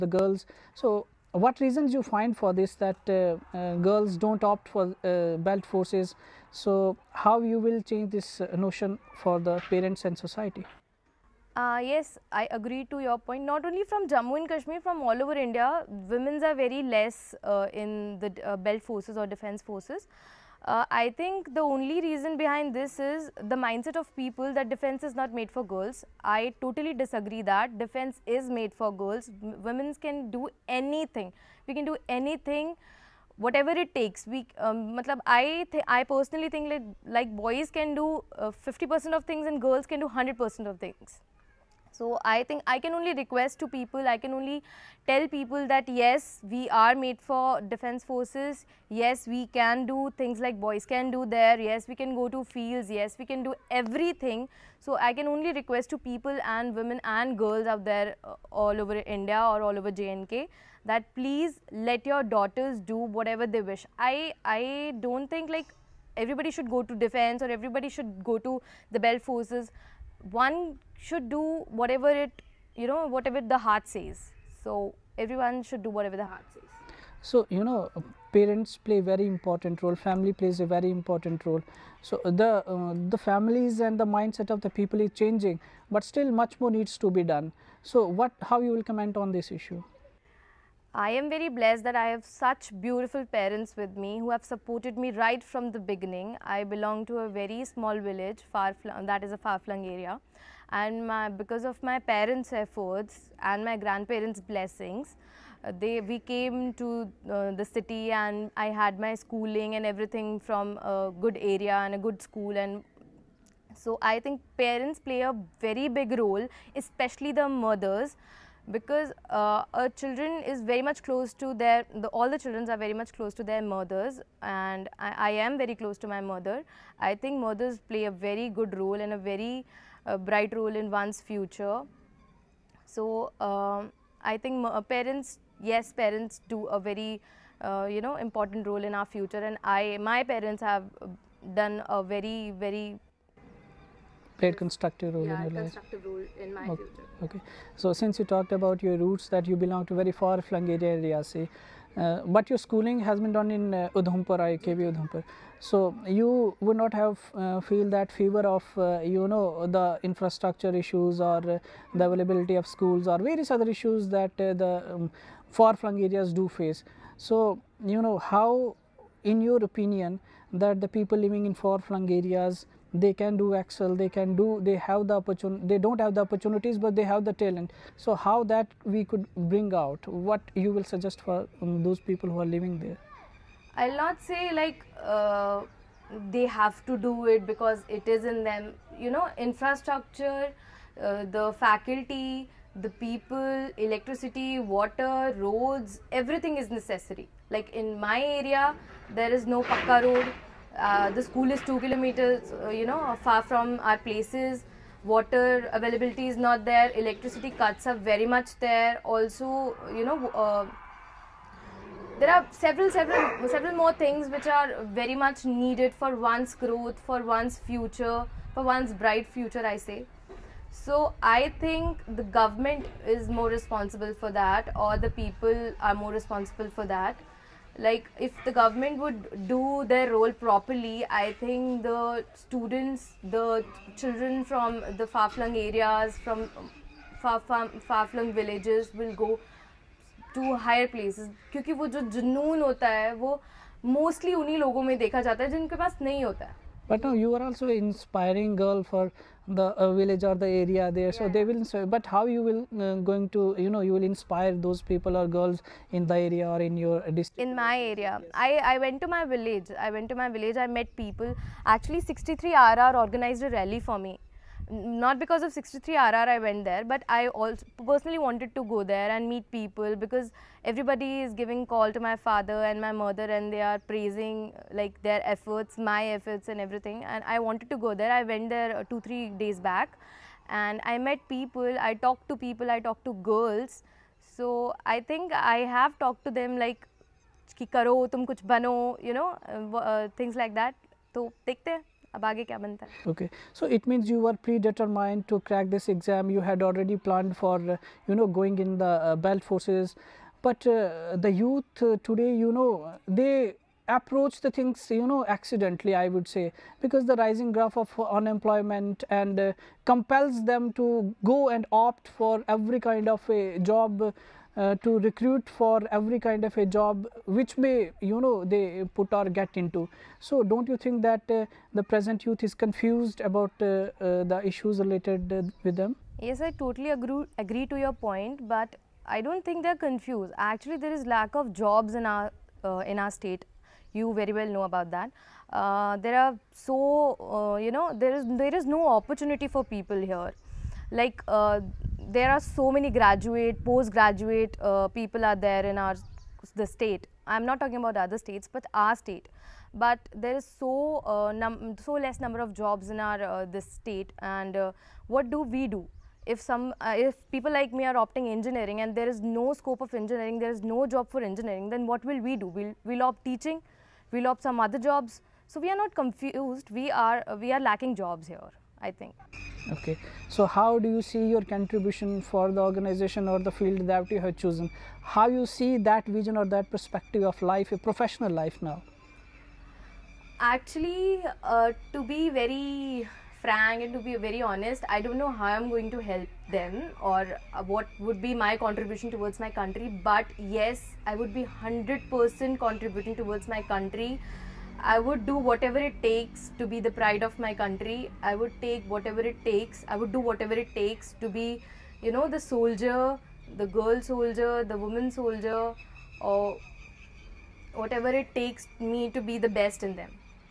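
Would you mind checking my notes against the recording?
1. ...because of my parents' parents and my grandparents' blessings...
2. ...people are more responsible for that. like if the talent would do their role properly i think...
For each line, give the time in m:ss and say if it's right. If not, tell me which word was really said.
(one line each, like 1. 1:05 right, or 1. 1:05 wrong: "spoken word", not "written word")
1. 1:41 wrong: "efforts", not "parents"
2. 3:45 wrong: "government", not "talent".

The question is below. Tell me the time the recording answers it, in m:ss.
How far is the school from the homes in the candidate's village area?
3:21.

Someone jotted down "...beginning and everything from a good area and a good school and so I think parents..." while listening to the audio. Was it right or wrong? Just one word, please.
wrong.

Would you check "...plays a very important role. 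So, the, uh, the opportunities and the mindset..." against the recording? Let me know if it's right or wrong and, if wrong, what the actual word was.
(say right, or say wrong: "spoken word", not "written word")
wrong: "families", not "opportunities".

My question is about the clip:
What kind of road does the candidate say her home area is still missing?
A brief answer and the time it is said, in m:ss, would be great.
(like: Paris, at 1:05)
Pakka road, at 3:19.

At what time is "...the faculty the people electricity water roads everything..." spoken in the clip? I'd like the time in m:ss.
3:11.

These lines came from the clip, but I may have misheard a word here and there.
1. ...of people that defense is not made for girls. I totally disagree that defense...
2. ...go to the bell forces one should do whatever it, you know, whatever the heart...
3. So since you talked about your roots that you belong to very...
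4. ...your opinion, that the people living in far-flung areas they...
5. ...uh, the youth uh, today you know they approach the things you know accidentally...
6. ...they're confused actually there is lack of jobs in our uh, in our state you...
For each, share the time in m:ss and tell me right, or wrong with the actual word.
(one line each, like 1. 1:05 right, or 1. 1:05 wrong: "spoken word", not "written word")
1. 0:23 right
2. 1:08 right
3. 2:27 right
4. 2:49 right
5. 5:00 right
6. 5:29 right.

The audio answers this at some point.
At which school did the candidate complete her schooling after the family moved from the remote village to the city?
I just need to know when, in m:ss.
2:34.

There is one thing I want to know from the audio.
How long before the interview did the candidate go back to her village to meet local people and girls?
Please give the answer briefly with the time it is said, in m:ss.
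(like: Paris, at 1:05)
Two, three days, at 4:38.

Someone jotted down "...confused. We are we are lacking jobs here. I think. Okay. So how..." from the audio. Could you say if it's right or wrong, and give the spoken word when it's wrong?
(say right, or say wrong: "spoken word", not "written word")
right.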